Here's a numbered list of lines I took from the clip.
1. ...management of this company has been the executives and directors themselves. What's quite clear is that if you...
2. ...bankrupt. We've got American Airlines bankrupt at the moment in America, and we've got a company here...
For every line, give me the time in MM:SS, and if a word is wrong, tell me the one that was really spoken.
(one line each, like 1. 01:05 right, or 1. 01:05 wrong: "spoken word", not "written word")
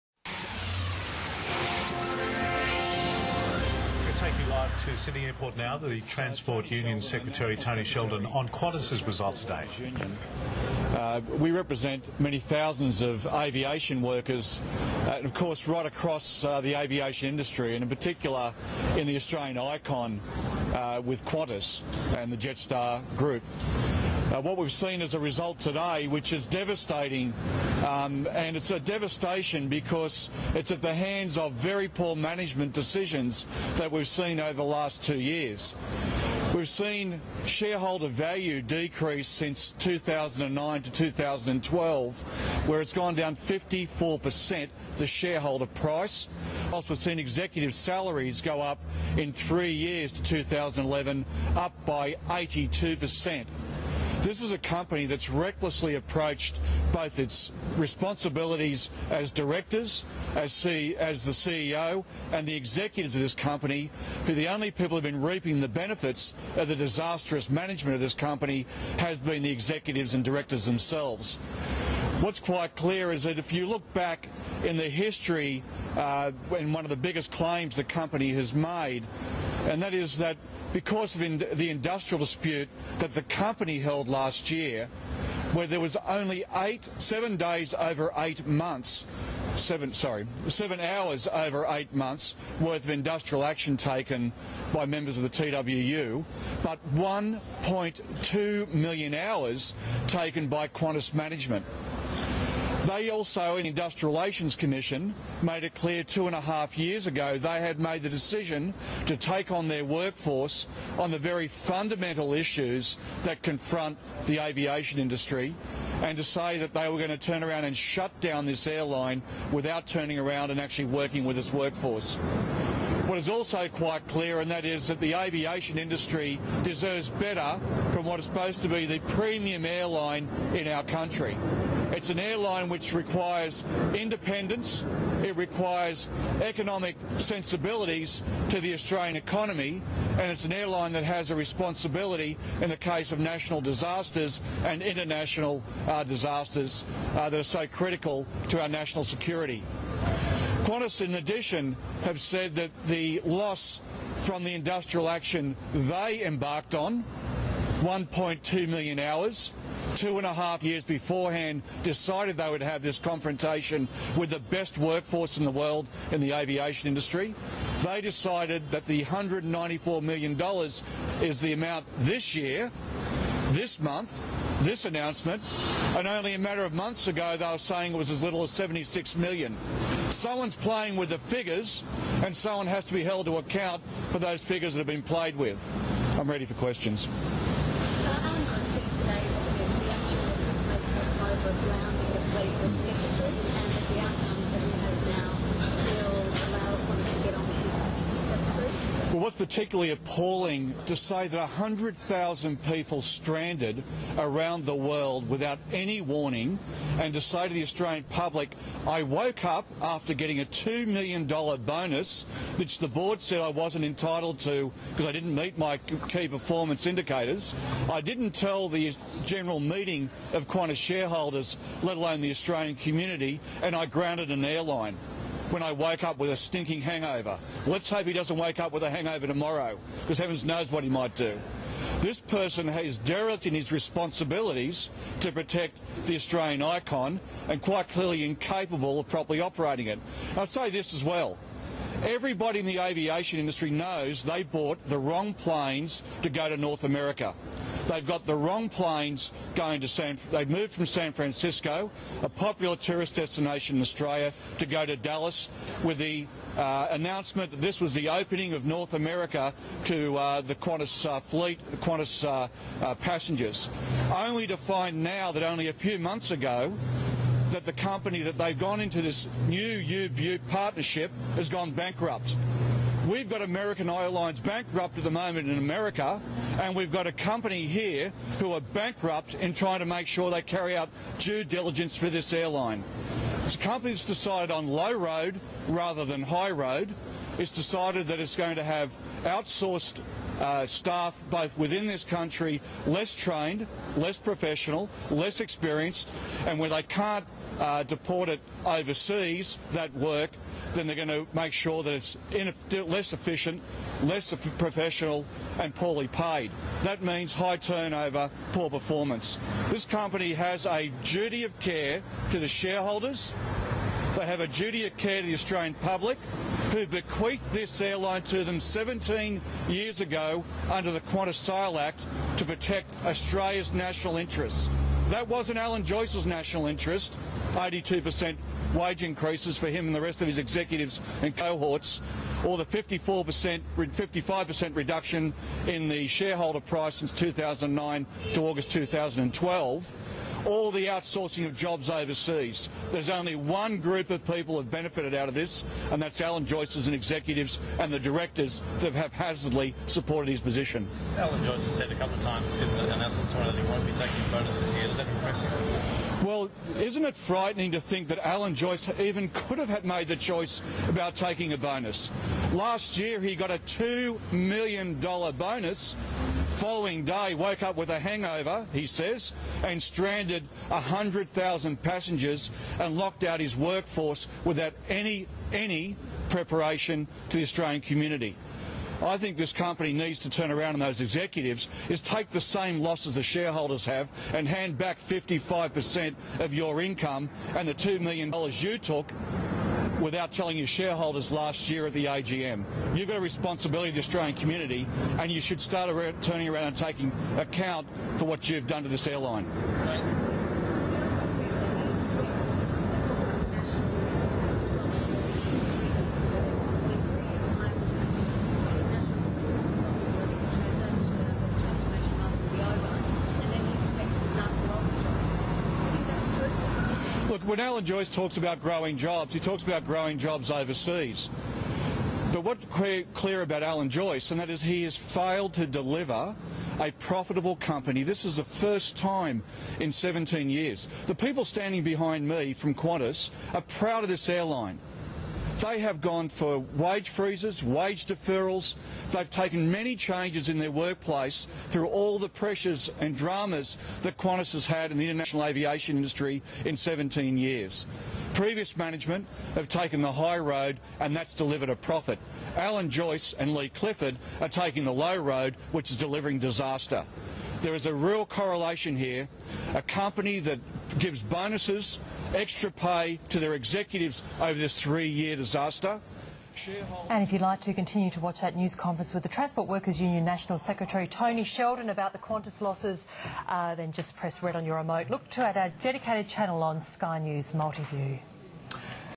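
1. 01:07 right
2. 04:31 right.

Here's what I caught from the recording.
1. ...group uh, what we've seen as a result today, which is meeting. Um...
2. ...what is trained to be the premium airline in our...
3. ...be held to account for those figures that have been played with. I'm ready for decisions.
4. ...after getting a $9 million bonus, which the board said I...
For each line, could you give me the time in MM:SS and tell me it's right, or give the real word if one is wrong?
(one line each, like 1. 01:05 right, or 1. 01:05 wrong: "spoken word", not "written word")
1. 00:23 wrong: "devastating", not "meeting"
2. 02:08 wrong: "supposed", not "trained"
3. 03:02 wrong: "questions", not "decisions"
4. 03:29 wrong: "2", not "9".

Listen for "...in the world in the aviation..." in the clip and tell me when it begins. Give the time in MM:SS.
02:45.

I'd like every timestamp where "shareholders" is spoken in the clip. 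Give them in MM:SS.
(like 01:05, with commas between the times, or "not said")
00:37, 00:45, 03:40, 05:12, 05:36, 06:23, 06:30.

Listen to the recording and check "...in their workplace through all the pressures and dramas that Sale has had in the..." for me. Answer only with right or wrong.
wrong.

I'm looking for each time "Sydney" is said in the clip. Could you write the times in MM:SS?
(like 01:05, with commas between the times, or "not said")
00:04.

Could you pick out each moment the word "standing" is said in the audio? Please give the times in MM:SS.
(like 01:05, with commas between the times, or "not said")
07:11.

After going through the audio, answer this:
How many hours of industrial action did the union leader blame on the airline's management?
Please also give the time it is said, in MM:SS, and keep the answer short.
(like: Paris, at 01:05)
1.2 million hours, at 01:36.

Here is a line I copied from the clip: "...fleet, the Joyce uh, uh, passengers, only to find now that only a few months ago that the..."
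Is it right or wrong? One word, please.
wrong.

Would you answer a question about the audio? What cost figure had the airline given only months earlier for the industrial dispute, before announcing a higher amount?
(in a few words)
76 million.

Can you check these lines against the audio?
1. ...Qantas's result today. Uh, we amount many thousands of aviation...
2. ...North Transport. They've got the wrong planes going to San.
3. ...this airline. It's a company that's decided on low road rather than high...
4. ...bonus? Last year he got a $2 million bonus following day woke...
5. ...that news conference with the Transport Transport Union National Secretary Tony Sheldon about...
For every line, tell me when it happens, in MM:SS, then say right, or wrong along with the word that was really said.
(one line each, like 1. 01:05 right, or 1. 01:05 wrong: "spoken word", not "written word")
1. 00:08 wrong: "represent", not "amount"
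2. 04:06 wrong: "America", not "Transport"
3. 04:42 right
4. 06:01 right
5. 07:48 wrong: "Workers", not "Transport".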